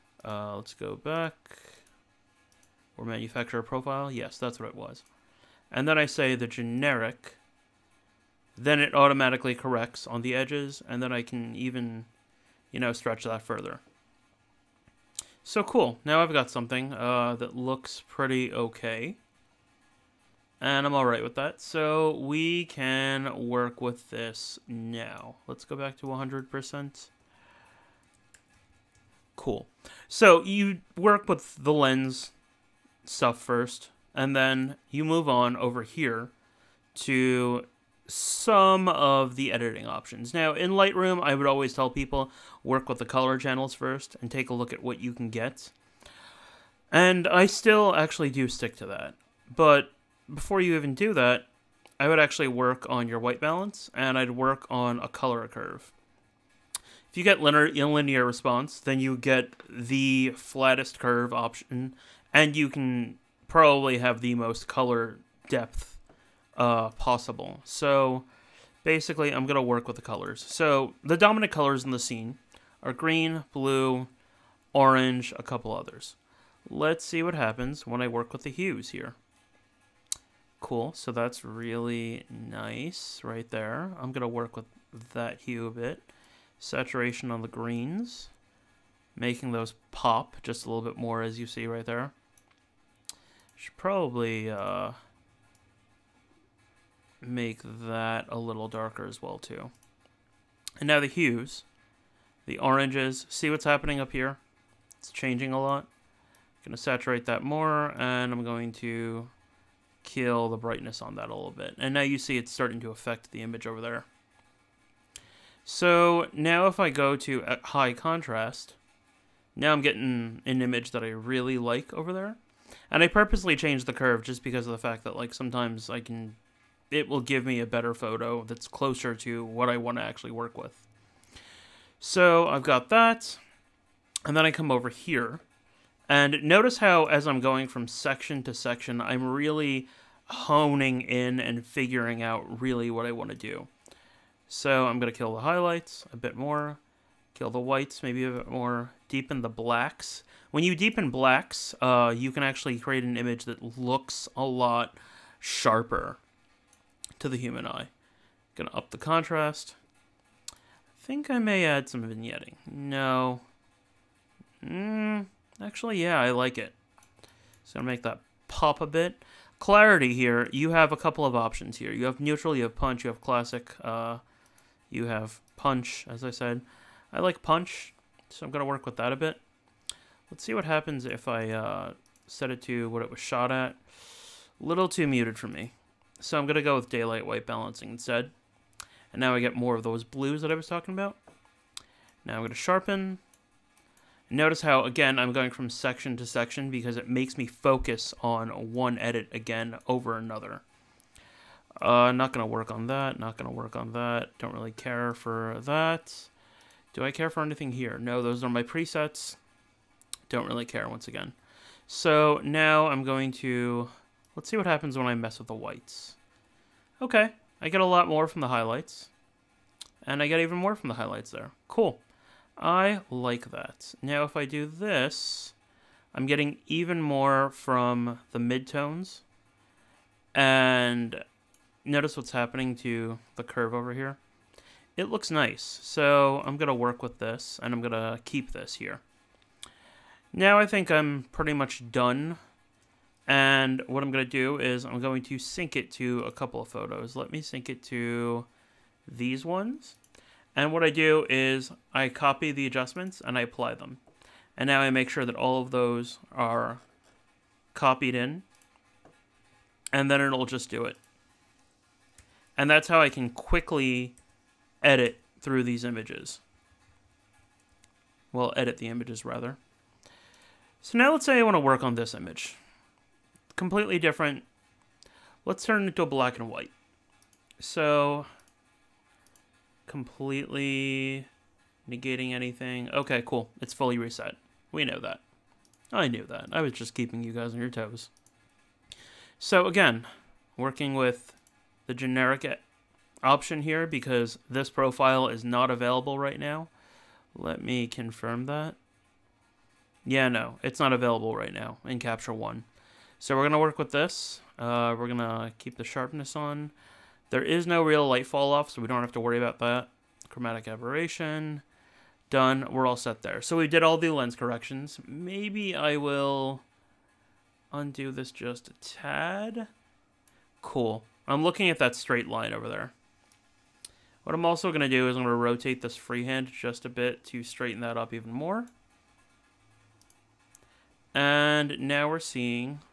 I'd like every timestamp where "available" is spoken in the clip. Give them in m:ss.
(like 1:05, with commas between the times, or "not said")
4:55, 5:00.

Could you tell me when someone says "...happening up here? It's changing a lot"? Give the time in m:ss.
1:43.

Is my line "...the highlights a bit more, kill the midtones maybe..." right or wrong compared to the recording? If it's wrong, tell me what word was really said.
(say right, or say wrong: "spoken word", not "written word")
wrong: "whites", not "midtones".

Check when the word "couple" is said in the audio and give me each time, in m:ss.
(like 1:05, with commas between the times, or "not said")
1:15, 2:50, 4:06.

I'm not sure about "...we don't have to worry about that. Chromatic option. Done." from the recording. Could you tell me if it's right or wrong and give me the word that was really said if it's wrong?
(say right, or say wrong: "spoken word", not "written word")
wrong: "aberration", not "option".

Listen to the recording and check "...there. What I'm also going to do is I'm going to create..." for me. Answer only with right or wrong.
wrong.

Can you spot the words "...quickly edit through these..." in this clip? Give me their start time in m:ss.
4:23.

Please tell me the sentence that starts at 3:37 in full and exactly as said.
Okay, I get a lot more from the highlights.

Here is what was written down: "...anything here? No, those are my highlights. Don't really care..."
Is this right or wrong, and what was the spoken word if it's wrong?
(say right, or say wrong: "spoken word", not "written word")
wrong: "presets", not "highlights".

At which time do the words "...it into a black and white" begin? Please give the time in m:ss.
4:35.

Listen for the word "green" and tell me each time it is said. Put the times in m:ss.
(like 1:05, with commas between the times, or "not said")
1:12, 1:27.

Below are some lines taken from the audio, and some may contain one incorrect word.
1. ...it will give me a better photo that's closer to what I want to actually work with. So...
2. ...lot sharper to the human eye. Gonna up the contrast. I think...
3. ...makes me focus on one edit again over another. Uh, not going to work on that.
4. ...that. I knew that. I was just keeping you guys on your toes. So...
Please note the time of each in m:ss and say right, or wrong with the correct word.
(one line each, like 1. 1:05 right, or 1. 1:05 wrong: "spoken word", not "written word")
1. 2:06 right
2. 2:34 right
3. 3:17 right
4. 4:45 right.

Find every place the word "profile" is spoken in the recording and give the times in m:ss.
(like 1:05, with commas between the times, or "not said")
0:03, 4:54.